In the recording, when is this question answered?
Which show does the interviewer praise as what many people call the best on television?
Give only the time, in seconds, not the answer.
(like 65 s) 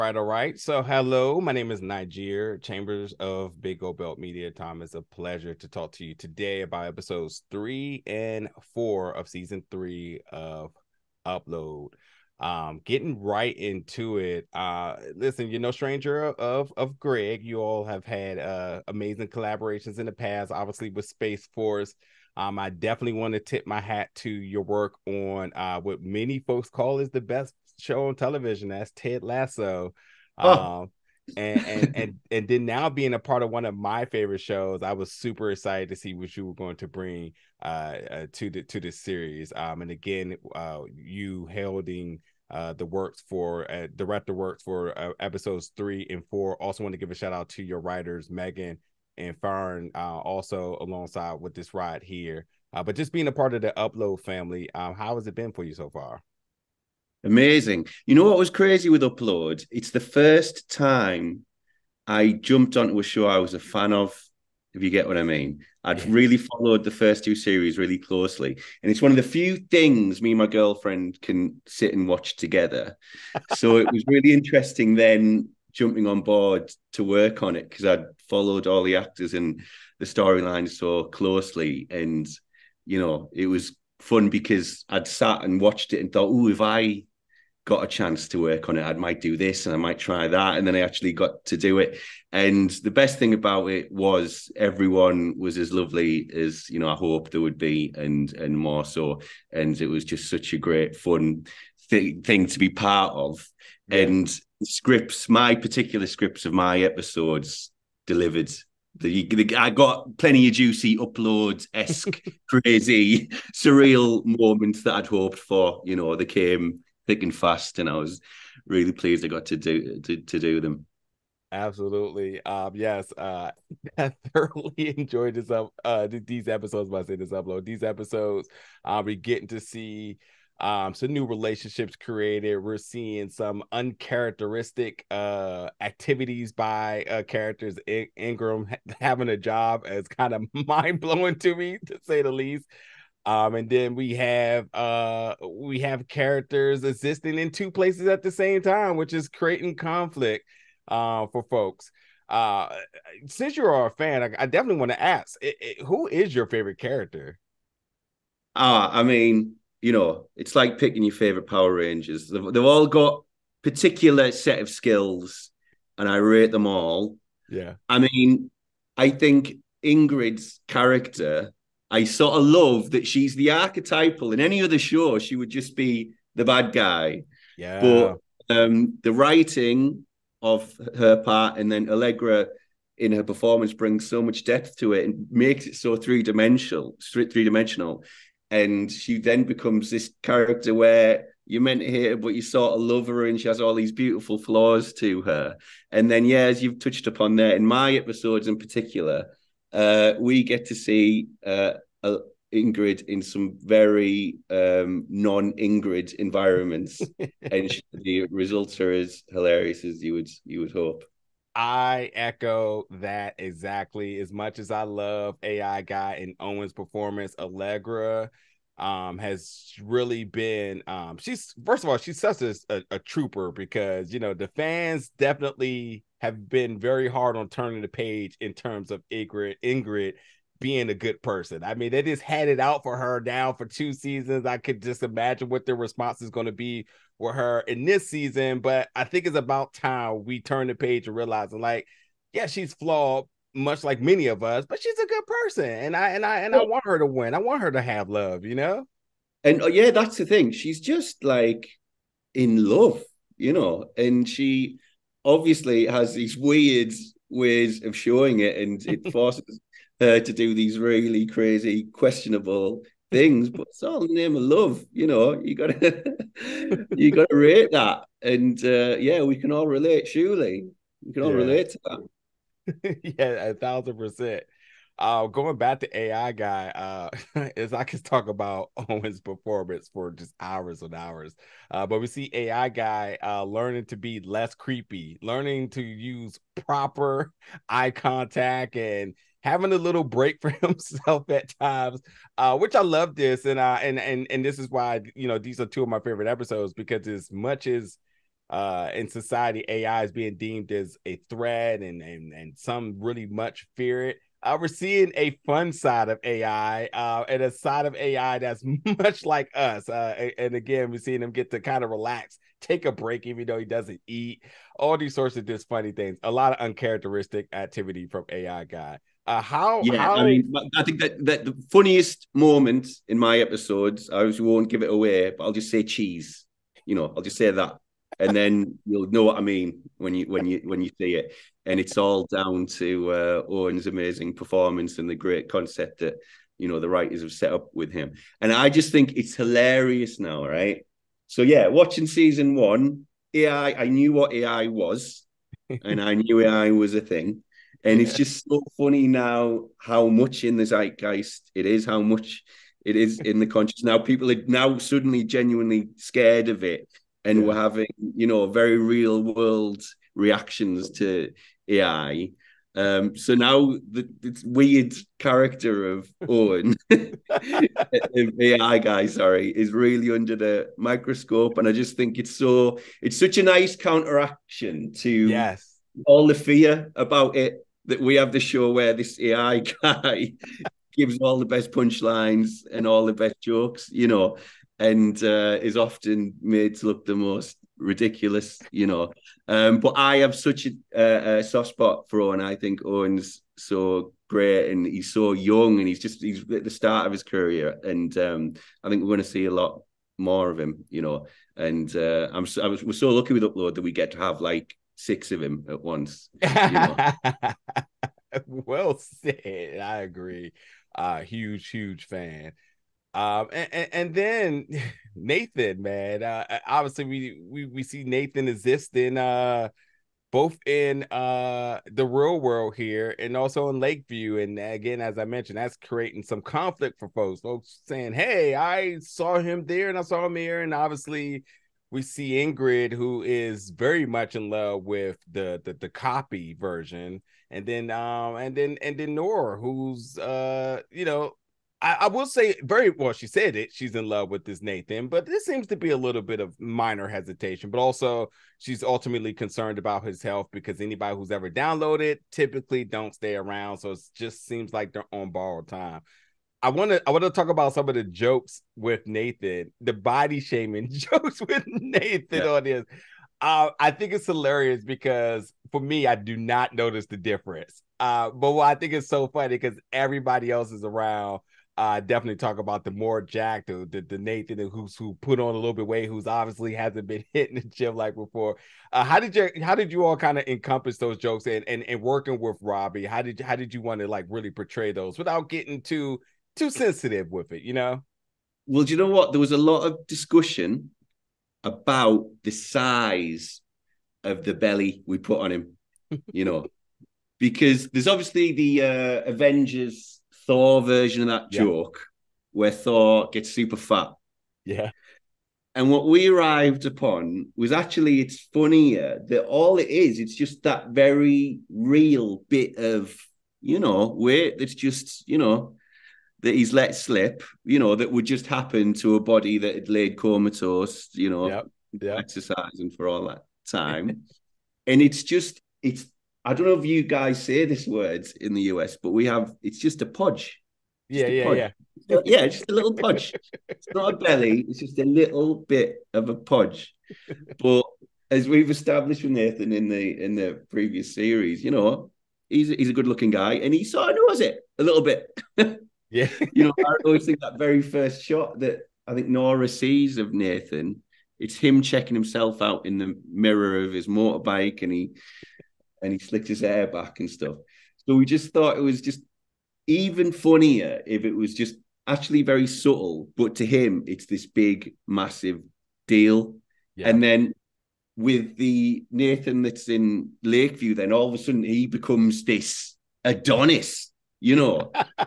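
28 s.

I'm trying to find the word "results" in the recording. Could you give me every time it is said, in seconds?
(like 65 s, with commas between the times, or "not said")
208 s.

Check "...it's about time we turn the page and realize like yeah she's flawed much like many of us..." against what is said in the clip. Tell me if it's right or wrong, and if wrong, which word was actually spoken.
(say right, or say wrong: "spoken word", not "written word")
right.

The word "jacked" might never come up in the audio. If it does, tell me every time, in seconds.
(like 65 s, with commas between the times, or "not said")
473 s.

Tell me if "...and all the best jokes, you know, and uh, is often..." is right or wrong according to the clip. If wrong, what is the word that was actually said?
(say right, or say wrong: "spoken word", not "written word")
right.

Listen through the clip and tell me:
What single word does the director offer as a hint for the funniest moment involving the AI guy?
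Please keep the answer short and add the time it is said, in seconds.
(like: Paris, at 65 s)
cheese, at 325 s.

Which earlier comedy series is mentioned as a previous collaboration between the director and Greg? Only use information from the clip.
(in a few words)
Space Force.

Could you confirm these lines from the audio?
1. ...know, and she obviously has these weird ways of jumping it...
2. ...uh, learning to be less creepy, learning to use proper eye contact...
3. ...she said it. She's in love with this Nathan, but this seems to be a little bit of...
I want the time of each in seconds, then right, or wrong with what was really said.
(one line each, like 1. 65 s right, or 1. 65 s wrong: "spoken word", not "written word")
1. 253 s wrong: "showing", not "jumping"
2. 283 s right
3. 443 s right.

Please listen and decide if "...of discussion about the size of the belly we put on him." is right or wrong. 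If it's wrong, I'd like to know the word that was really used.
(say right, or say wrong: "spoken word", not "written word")
right.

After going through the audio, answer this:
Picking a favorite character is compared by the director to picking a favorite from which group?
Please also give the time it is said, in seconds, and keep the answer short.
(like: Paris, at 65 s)
Power Rangers, at 161 s.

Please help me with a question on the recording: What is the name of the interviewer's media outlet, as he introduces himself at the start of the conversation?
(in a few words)
Big Gold Belt Media.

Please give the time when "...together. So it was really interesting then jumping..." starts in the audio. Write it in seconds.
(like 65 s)
72 s.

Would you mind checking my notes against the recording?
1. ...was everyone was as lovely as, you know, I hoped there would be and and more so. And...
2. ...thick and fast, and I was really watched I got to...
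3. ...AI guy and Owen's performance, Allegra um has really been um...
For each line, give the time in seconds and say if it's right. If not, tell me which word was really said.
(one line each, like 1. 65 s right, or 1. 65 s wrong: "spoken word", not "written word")
1. 93 s right
2. 117 s wrong: "pleased", not "watched"
3. 215 s right.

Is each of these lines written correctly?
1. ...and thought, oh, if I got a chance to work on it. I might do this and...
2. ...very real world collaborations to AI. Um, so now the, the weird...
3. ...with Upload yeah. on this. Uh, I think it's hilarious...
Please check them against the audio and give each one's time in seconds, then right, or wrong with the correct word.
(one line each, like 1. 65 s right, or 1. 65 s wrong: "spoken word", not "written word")
1. 86 s right
2. 358 s wrong: "reactions", not "collaborations"
3. 461 s wrong: "Nathan", not "Upload".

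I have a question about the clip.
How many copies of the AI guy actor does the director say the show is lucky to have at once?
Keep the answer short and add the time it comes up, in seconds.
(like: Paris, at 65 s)
6, at 404 s.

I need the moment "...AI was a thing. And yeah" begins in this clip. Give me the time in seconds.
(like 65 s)
346 s.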